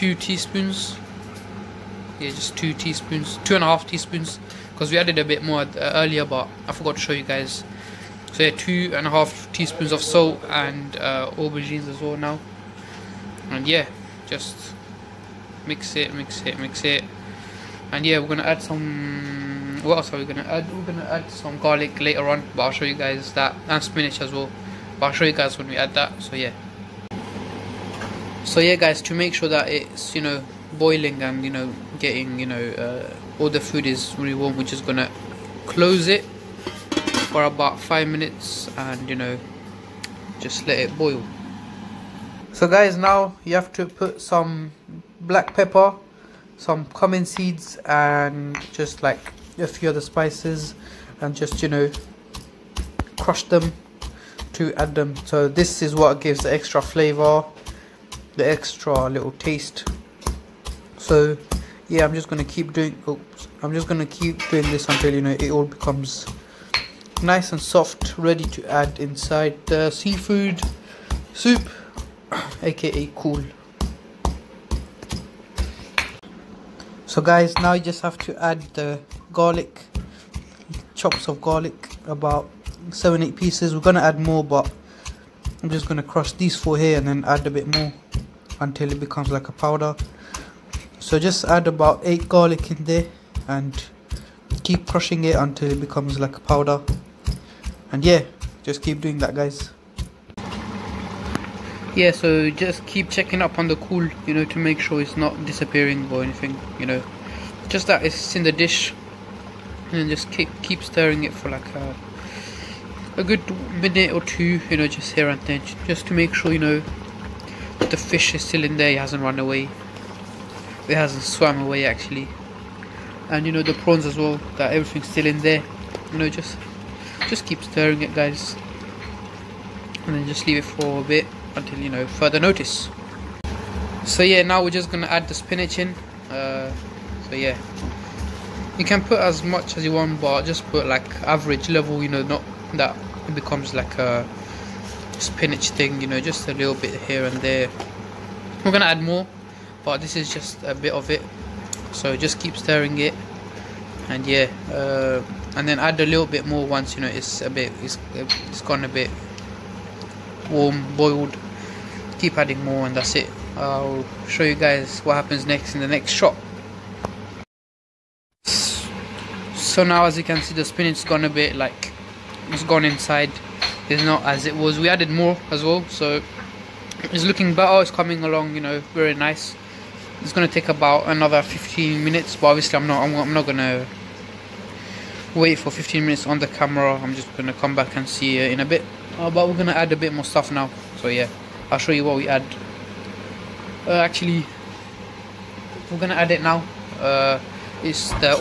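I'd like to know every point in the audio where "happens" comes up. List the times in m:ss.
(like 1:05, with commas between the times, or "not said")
2:45.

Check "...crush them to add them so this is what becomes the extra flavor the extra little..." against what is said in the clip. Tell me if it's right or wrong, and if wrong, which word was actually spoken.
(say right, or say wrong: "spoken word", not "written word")
wrong: "gives", not "becomes".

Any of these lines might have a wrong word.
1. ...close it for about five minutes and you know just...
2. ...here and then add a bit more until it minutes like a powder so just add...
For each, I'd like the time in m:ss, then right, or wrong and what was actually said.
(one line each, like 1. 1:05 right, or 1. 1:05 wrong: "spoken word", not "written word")
1. 0:35 right
2. 1:26 wrong: "becomes", not "minutes".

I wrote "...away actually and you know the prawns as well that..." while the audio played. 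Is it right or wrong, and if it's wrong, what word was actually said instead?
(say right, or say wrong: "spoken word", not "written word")
right.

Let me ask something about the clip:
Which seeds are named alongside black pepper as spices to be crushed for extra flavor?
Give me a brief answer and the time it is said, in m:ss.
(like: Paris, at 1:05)
cumin seeds, at 0:46.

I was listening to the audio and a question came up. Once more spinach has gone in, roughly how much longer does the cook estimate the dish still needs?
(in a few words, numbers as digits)
15 minutes.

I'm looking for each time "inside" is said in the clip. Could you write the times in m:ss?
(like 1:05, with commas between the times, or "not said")
1:08, 2:52.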